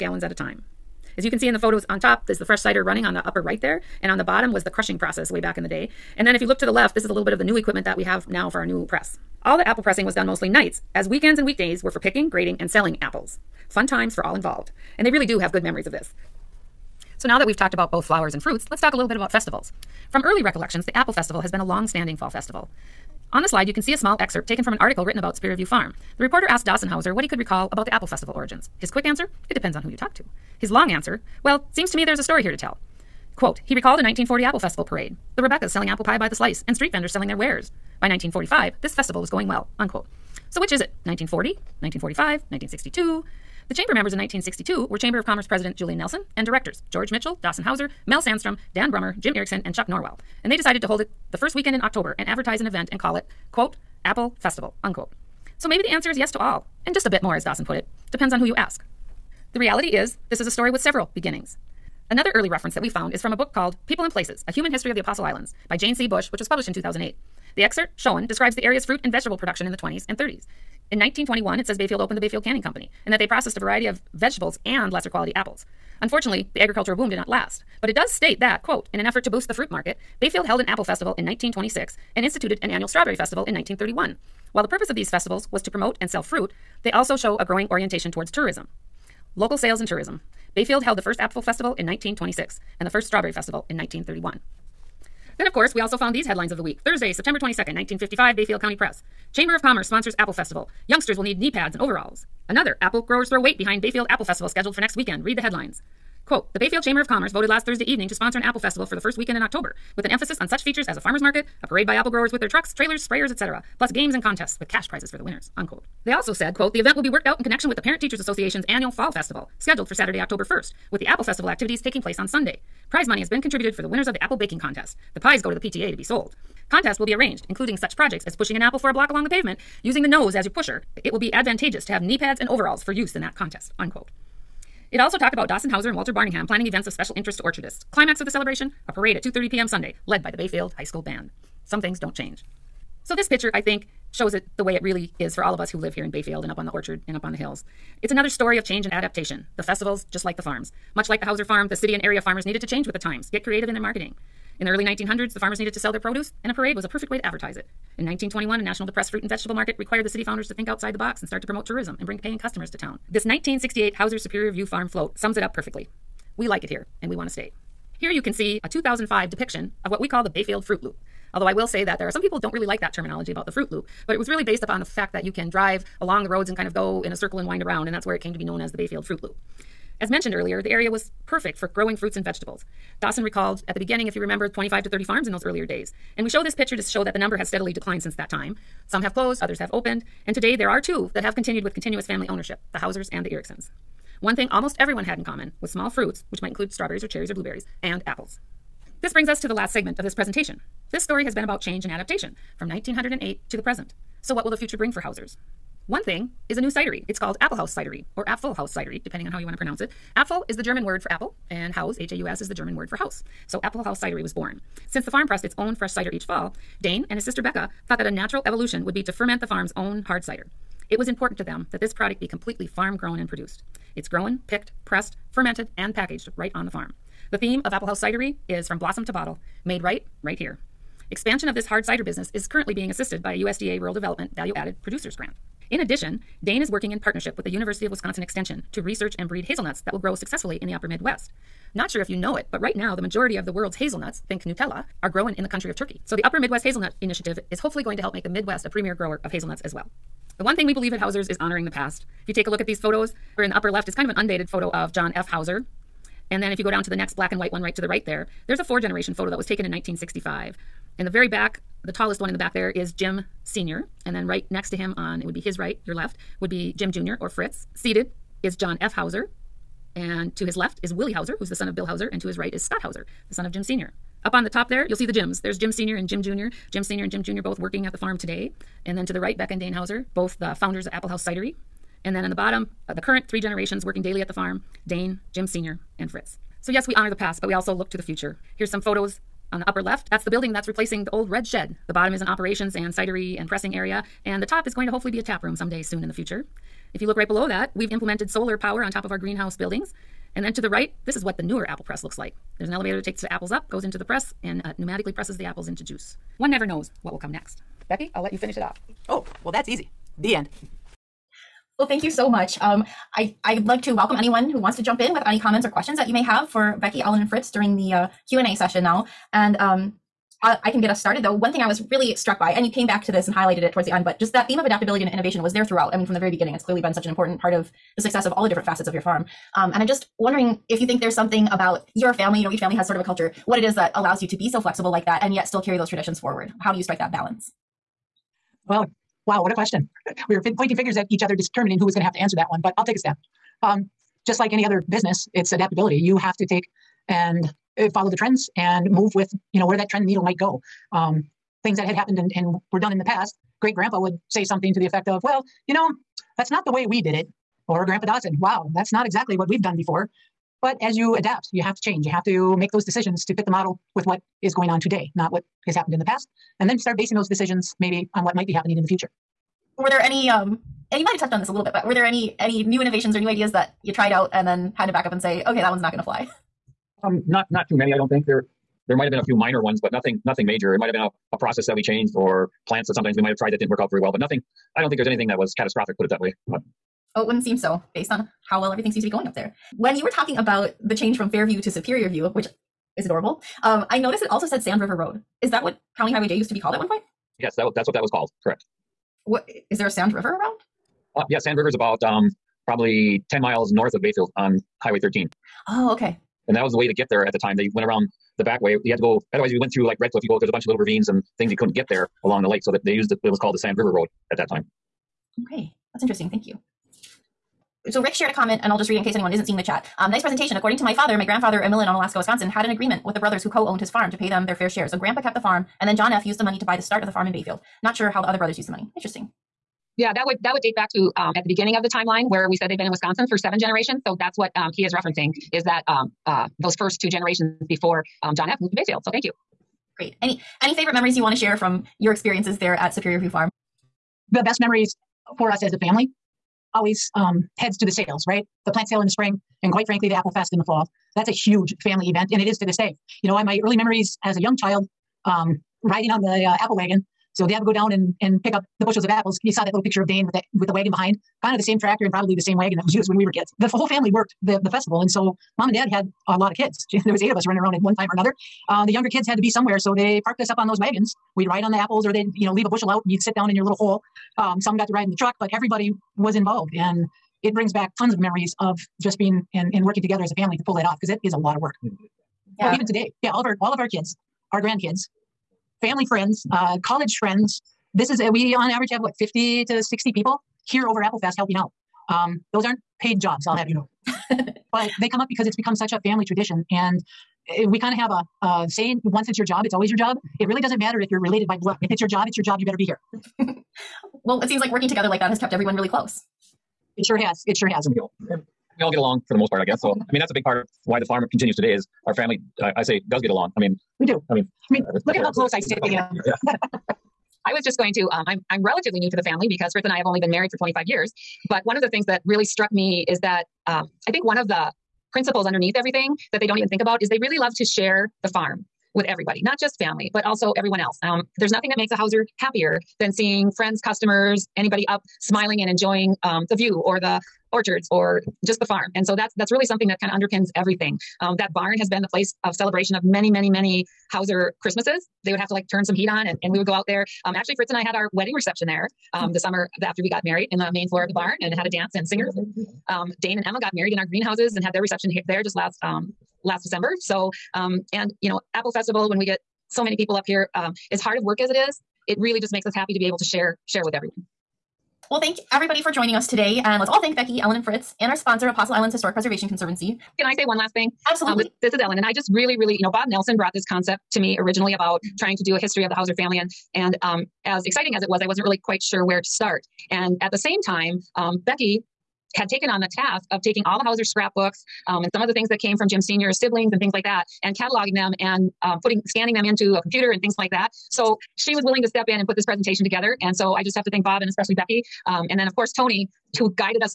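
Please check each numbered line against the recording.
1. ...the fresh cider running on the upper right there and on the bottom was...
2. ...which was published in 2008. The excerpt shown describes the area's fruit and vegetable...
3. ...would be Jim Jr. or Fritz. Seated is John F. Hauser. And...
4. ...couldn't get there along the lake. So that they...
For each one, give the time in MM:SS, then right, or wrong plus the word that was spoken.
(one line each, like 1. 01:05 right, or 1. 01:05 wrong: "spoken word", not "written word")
1. 00:02 right
2. 01:06 right
3. 04:26 right
4. 06:51 right.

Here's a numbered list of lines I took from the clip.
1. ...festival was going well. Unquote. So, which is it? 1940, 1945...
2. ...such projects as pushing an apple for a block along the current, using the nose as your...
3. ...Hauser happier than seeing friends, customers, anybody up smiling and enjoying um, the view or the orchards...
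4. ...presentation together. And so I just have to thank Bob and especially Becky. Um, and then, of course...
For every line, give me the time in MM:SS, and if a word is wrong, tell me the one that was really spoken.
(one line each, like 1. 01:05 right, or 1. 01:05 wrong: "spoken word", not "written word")
1. 00:38 right
2. 02:07 wrong: "pavement", not "current"
3. 08:51 right
4. 09:52 right.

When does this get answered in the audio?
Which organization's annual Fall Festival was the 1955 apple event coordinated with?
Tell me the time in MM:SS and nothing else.
01:57.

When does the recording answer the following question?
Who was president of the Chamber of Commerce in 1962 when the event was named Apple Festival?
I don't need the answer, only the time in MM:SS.
00:45.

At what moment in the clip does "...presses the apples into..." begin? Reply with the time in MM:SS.
05:05.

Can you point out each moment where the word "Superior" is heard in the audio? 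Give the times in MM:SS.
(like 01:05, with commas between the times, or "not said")
00:25, 02:44, 06:31, 07:22.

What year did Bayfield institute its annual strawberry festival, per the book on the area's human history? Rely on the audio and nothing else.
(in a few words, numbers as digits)
1931.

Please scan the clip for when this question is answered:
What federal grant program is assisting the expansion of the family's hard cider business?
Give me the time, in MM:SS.
03:54.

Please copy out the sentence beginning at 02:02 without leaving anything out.
Prize money has been contributed for the winners of the Apple Baking Contest.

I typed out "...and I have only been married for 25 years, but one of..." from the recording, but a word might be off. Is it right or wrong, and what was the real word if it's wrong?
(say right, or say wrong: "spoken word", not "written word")
right.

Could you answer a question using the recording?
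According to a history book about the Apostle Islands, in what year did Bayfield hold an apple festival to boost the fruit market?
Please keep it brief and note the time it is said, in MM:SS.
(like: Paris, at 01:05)
1926, at 01:20.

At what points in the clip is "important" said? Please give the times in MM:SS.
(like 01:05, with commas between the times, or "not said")
03:41, 05:27.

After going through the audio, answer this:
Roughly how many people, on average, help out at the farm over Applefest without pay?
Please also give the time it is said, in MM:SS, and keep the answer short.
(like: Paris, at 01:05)
50 to 60, at 08:09.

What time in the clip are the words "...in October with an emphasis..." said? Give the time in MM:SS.
01:49.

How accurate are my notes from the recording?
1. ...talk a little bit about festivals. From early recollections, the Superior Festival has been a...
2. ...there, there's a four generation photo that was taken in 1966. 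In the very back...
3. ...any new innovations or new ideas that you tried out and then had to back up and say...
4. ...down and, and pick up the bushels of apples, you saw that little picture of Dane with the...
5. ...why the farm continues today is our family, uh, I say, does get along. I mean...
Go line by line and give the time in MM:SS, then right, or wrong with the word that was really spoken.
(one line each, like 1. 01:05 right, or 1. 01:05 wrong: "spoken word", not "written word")
1. 00:18 wrong: "Apple", not "Superior"
2. 04:18 wrong: "1965", not "1966"
3. 06:12 right
4. 07:37 right
5. 08:30 right.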